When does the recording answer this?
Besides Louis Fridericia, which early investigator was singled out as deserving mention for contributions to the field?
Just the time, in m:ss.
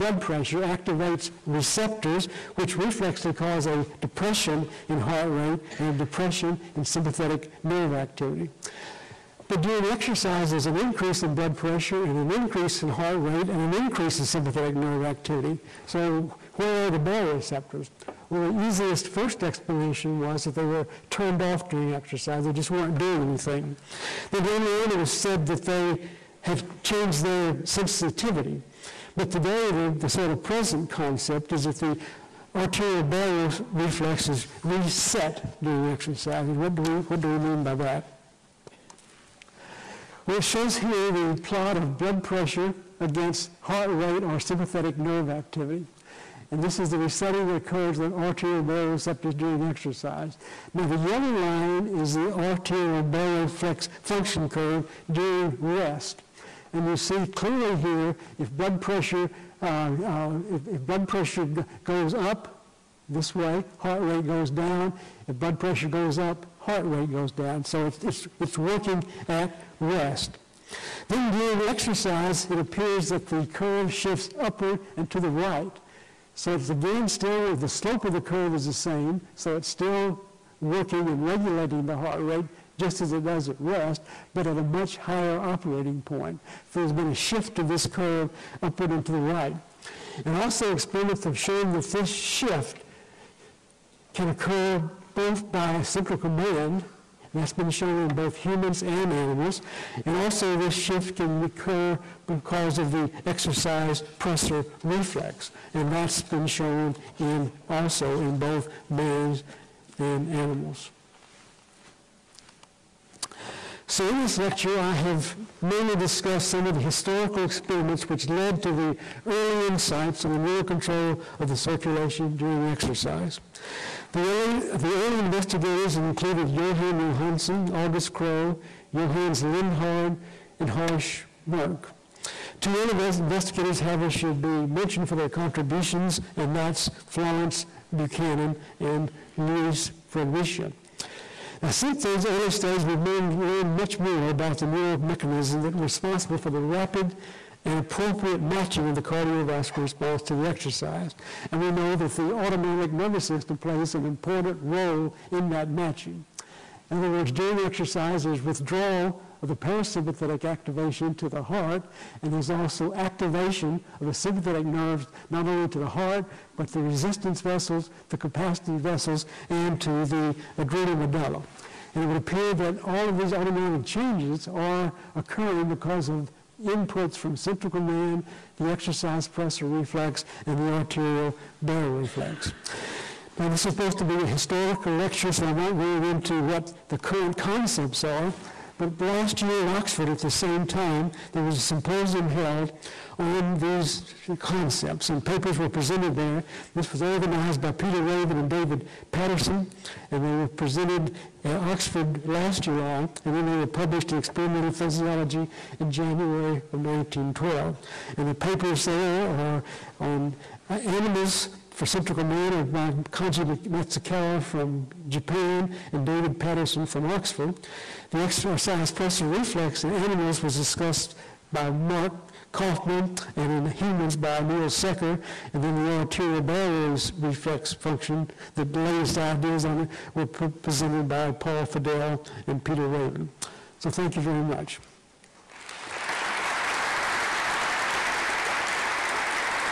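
2:17.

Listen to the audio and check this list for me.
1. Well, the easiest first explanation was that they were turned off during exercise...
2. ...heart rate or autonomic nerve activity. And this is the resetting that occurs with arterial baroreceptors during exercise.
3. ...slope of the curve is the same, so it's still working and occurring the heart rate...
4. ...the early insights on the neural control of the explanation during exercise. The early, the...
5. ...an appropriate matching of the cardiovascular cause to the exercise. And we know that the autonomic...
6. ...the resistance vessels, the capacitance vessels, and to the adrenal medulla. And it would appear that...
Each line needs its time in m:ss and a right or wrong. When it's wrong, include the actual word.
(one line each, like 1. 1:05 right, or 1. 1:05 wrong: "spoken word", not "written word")
1. 0:18 right
2. 0:43 wrong: "sympathetic", not "autonomic"
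3. 1:17 wrong: "regulating", not "occurring"
4. 1:58 wrong: "circulation", not "explanation"
5. 2:27 wrong: "response", not "cause"
6. 2:46 right.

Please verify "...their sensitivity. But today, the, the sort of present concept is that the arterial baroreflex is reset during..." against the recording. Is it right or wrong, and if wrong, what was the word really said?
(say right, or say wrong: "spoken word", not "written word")
right.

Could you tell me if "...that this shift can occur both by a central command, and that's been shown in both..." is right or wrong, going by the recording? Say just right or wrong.
right.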